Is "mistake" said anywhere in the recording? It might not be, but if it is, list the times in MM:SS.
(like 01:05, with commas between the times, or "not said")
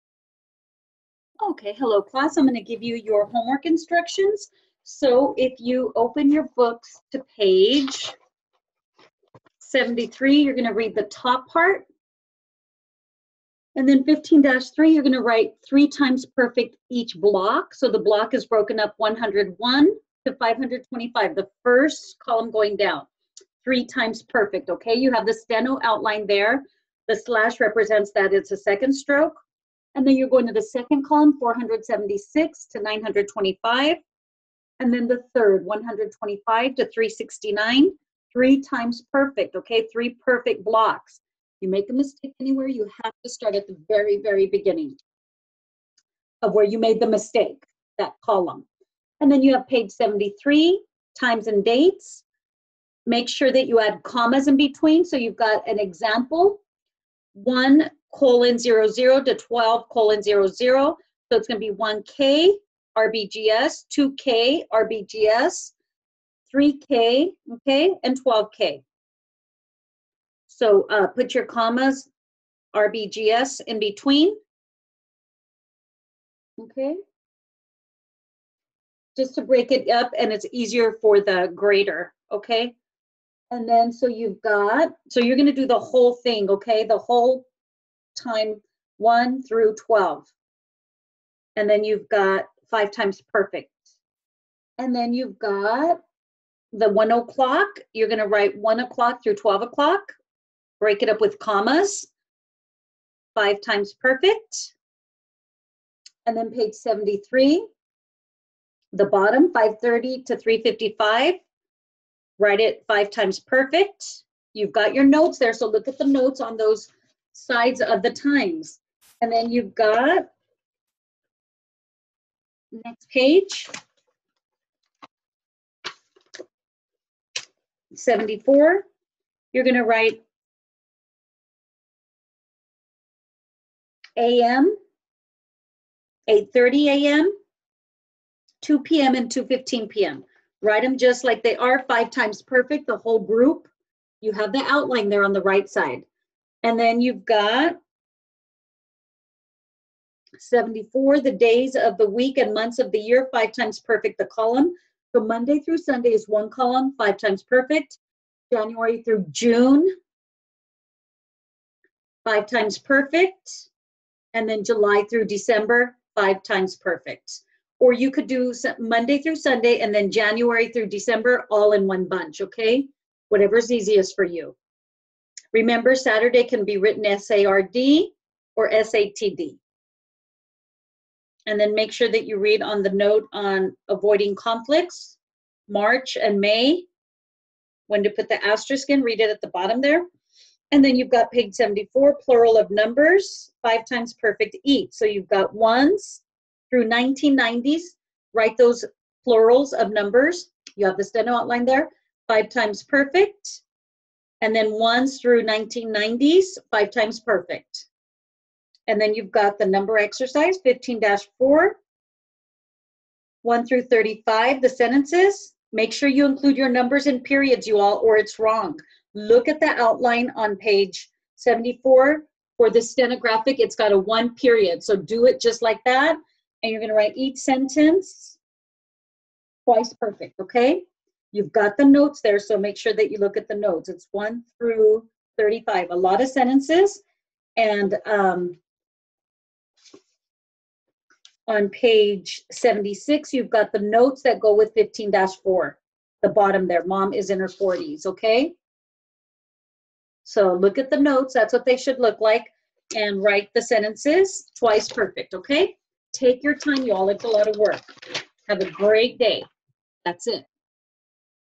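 00:41, 00:47.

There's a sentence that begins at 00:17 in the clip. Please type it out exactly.
So the block is broken up 101 to 525, the first column going down.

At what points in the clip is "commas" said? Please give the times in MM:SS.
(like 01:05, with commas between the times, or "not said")
00:54, 01:11, 01:41.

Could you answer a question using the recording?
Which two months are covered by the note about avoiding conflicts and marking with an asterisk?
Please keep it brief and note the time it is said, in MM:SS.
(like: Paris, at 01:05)
March and May, at 03:05.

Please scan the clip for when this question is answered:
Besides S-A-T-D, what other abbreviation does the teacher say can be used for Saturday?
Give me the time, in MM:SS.
02:57.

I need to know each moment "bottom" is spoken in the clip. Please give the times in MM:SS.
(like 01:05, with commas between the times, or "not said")
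01:49, 03:09, 04:06.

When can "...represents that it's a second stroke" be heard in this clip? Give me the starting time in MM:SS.
00:27.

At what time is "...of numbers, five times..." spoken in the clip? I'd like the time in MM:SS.
03:12.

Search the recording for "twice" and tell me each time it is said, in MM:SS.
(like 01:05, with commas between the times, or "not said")
03:49, 04:14.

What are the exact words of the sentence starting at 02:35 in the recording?
So Monday through Sunday is one column, five times perfect.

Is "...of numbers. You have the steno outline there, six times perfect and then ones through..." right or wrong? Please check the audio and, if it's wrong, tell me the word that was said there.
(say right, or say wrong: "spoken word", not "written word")
wrong: "five", not "six".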